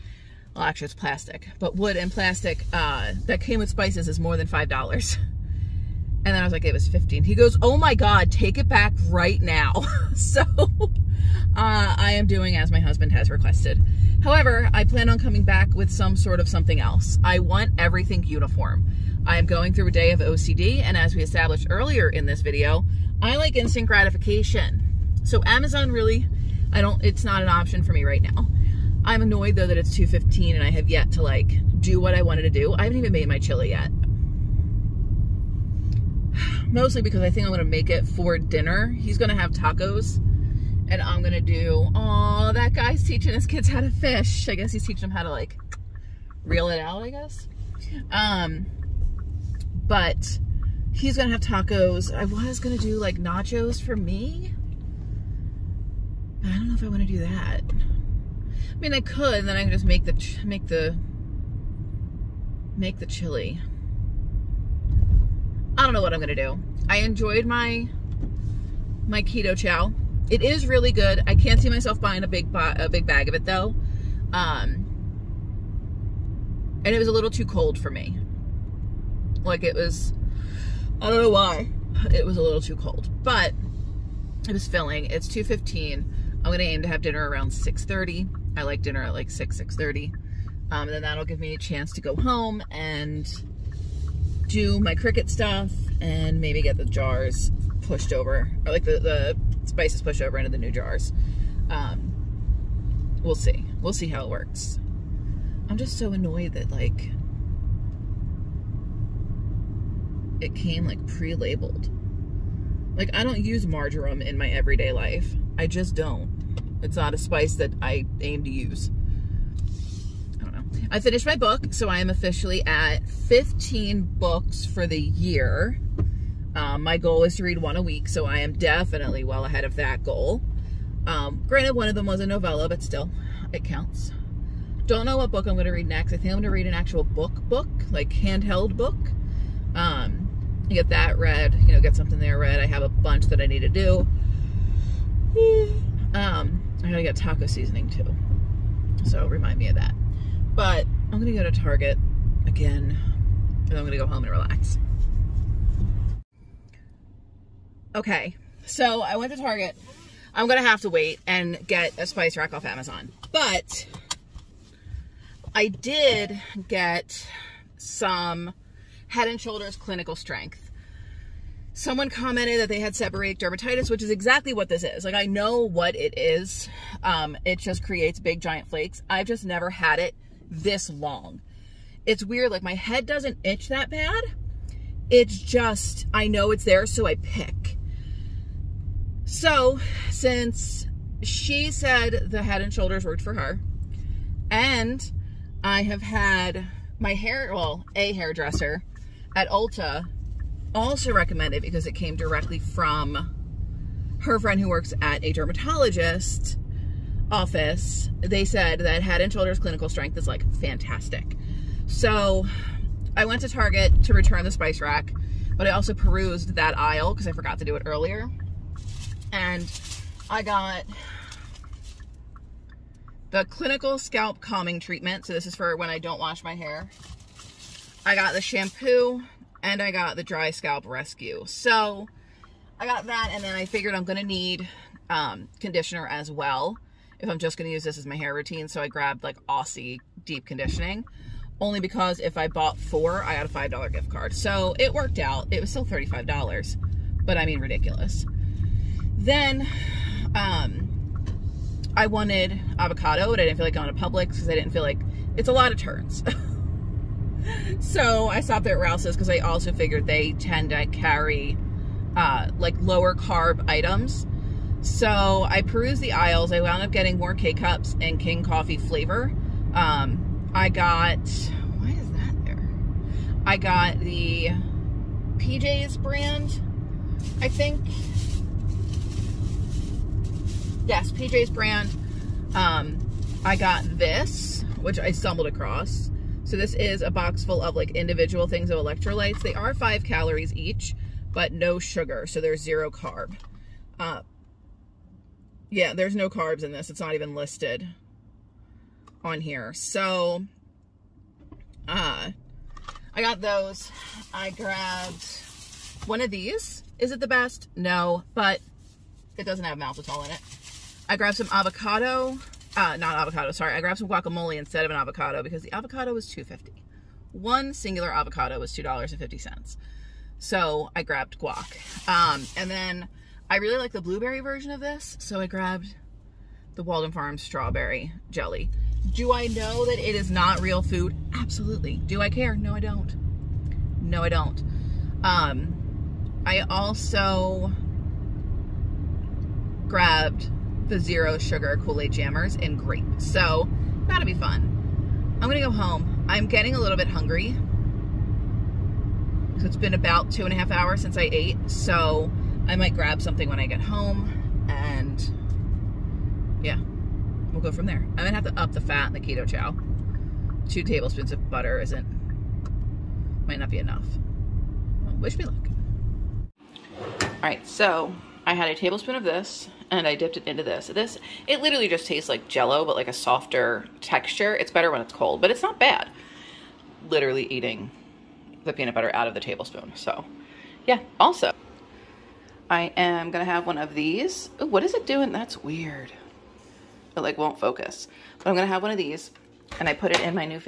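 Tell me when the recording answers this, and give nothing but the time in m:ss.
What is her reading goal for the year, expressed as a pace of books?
2:07.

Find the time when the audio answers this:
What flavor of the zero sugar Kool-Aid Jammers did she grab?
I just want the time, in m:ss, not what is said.
5:42.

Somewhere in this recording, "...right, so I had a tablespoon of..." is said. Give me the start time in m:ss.
6:07.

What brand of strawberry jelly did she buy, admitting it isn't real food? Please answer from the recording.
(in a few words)
Walden Farms.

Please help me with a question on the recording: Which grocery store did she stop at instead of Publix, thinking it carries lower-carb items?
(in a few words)
Rouse's.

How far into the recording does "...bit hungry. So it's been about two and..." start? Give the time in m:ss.
5:46.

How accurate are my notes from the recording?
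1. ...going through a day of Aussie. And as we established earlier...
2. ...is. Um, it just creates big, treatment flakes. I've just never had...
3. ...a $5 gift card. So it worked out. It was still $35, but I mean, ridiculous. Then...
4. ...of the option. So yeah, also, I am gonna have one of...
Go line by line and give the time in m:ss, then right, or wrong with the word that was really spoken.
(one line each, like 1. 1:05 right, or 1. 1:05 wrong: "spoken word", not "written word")
1. 0:19 wrong: "OCD", not "Aussie"
2. 2:56 wrong: "giant", not "treatment"
3. 4:03 right
4. 6:19 wrong: "tablespoon", not "option".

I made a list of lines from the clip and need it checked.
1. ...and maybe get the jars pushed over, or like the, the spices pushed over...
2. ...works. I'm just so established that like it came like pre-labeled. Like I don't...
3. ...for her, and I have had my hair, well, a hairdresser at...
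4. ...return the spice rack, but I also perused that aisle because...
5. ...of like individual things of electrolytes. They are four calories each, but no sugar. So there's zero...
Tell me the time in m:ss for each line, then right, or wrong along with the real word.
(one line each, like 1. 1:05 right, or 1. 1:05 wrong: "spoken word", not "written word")
1. 1:35 right
2. 1:44 wrong: "annoyed", not "established"
3. 3:13 right
4. 3:34 right
5. 4:47 wrong: "five", not "four".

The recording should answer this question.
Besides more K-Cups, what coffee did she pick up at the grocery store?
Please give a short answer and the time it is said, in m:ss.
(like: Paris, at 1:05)
King Coffee, at 4:28.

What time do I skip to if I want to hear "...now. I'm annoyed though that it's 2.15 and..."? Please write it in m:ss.
0:28.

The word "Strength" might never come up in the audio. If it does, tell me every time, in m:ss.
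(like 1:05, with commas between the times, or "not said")
2:50, 3:29.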